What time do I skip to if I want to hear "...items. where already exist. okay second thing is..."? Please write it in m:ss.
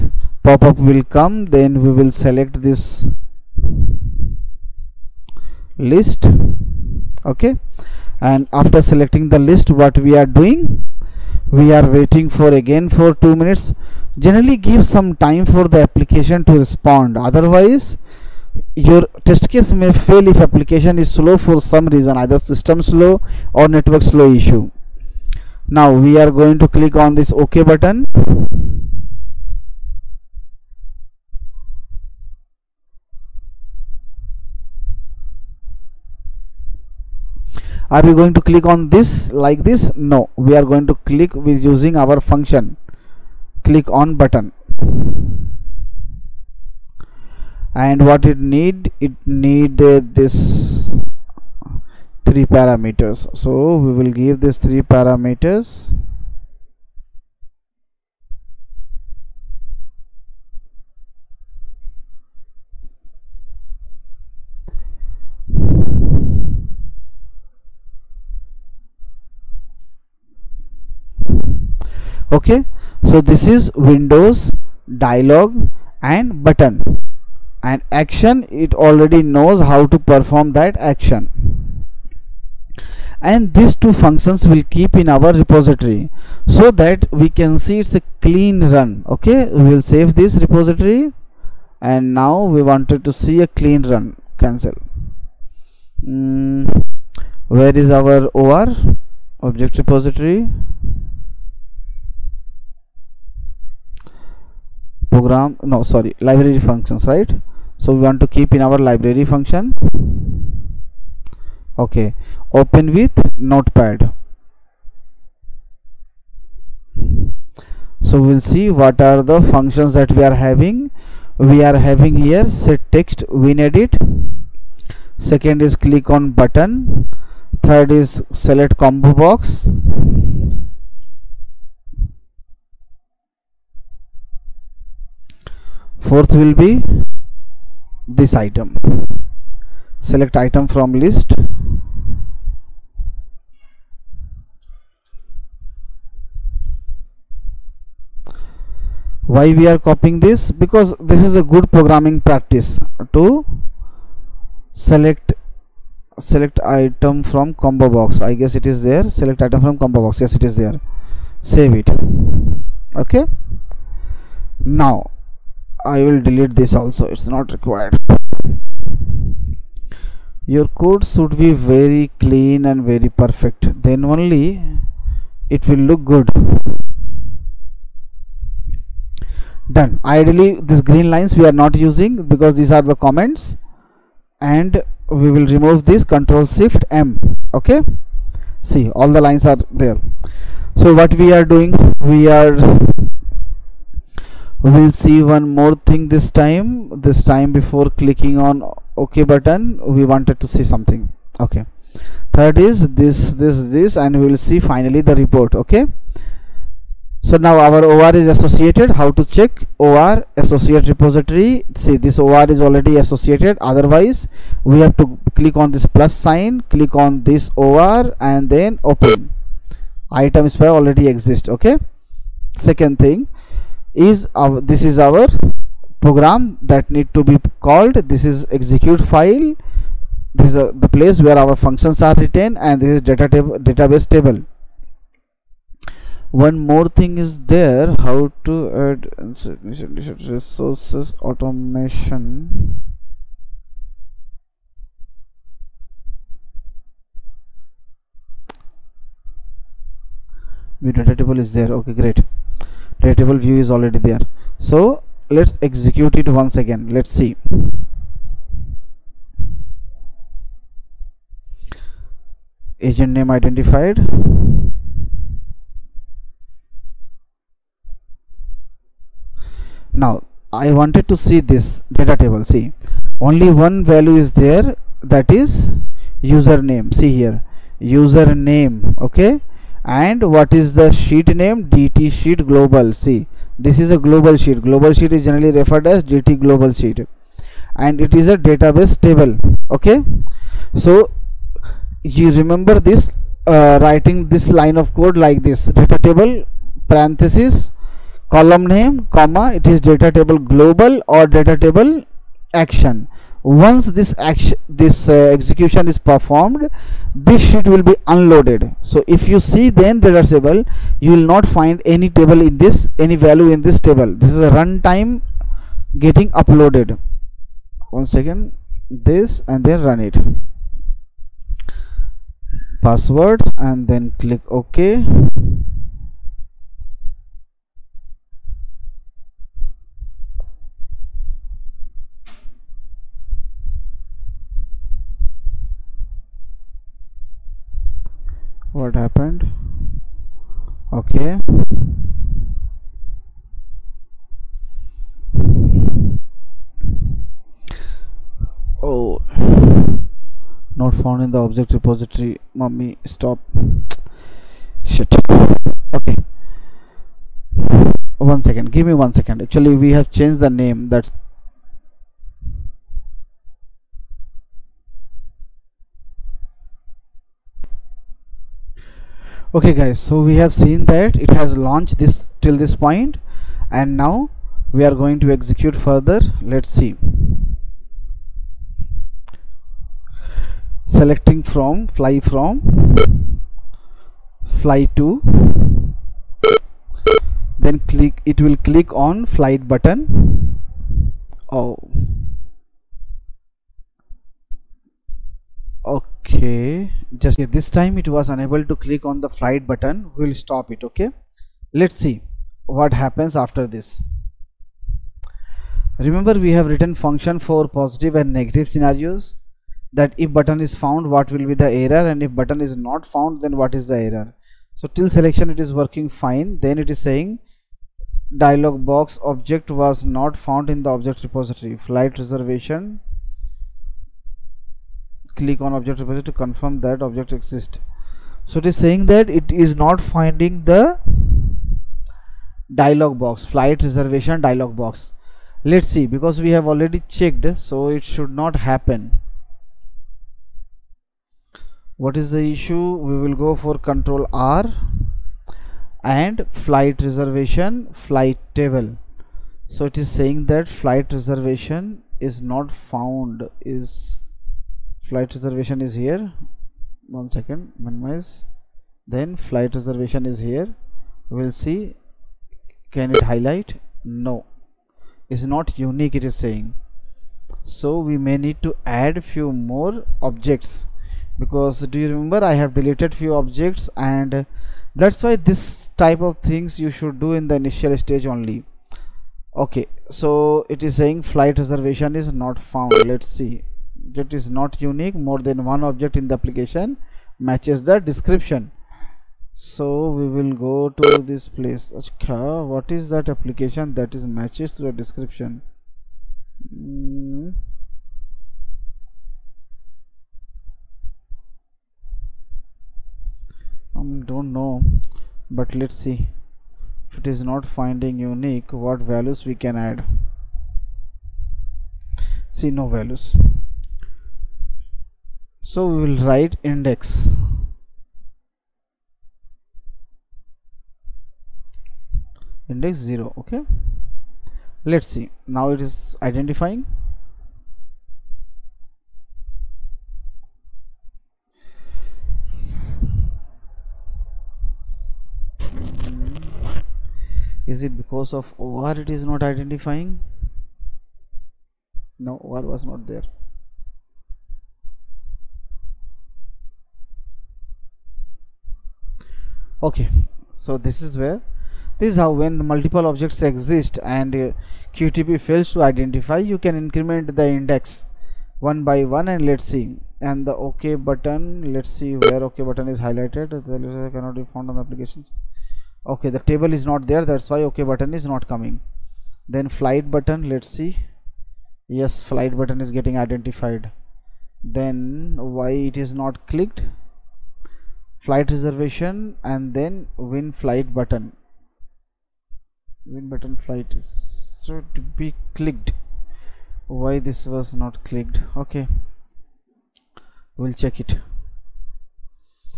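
3:40.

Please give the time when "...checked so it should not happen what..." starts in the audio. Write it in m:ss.
7:17.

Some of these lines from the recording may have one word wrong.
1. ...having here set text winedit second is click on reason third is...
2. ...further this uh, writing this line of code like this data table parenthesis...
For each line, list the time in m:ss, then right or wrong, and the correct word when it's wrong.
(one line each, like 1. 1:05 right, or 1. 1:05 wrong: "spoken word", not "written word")
1. 2:01 wrong: "button", not "reason"
2. 4:52 wrong: "remember", not "further".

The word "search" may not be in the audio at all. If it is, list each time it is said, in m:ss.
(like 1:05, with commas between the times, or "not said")
not said.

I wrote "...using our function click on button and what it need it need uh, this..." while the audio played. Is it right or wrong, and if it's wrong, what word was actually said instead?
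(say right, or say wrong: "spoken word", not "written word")
right.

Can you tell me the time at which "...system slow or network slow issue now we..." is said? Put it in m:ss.
0:22.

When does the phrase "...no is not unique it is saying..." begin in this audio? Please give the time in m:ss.
7:44.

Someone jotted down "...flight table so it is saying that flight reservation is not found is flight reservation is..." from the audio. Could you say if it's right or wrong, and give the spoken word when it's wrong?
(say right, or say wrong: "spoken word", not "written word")
right.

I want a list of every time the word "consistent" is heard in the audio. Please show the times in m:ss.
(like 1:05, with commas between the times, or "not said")
not said.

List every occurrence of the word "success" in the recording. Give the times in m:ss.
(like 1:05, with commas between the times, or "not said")
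not said.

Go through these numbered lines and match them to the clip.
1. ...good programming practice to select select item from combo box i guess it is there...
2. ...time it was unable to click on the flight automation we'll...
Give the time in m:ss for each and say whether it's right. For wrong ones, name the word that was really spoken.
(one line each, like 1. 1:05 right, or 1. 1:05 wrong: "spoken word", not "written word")
1. 2:31 right
2. 6:37 wrong: "button", not "automation".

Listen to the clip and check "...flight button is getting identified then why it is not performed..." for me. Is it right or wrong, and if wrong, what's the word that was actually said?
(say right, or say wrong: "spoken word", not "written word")
wrong: "clicked", not "performed".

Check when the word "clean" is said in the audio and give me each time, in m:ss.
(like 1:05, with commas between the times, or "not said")
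1:28, 1:33, 2:52.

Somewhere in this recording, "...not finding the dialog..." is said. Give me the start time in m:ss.
7:09.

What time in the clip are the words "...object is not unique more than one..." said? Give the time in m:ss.
8:04.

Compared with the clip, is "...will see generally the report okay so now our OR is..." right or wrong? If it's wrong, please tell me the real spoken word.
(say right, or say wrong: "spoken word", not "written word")
wrong: "finally", not "generally".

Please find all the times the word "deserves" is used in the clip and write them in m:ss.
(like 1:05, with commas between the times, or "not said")
not said.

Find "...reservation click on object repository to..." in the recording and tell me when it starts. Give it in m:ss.
7:02.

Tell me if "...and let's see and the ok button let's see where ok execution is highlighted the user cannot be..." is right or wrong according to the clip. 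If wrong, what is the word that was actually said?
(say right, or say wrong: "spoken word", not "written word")
wrong: "button", not "execution".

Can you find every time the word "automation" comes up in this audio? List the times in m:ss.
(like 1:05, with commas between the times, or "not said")
4:01.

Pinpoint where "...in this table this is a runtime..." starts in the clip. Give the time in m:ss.
5:13.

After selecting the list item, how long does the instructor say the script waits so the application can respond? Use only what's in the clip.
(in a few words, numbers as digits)
2 minutes.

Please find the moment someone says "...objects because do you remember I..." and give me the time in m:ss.
7:50.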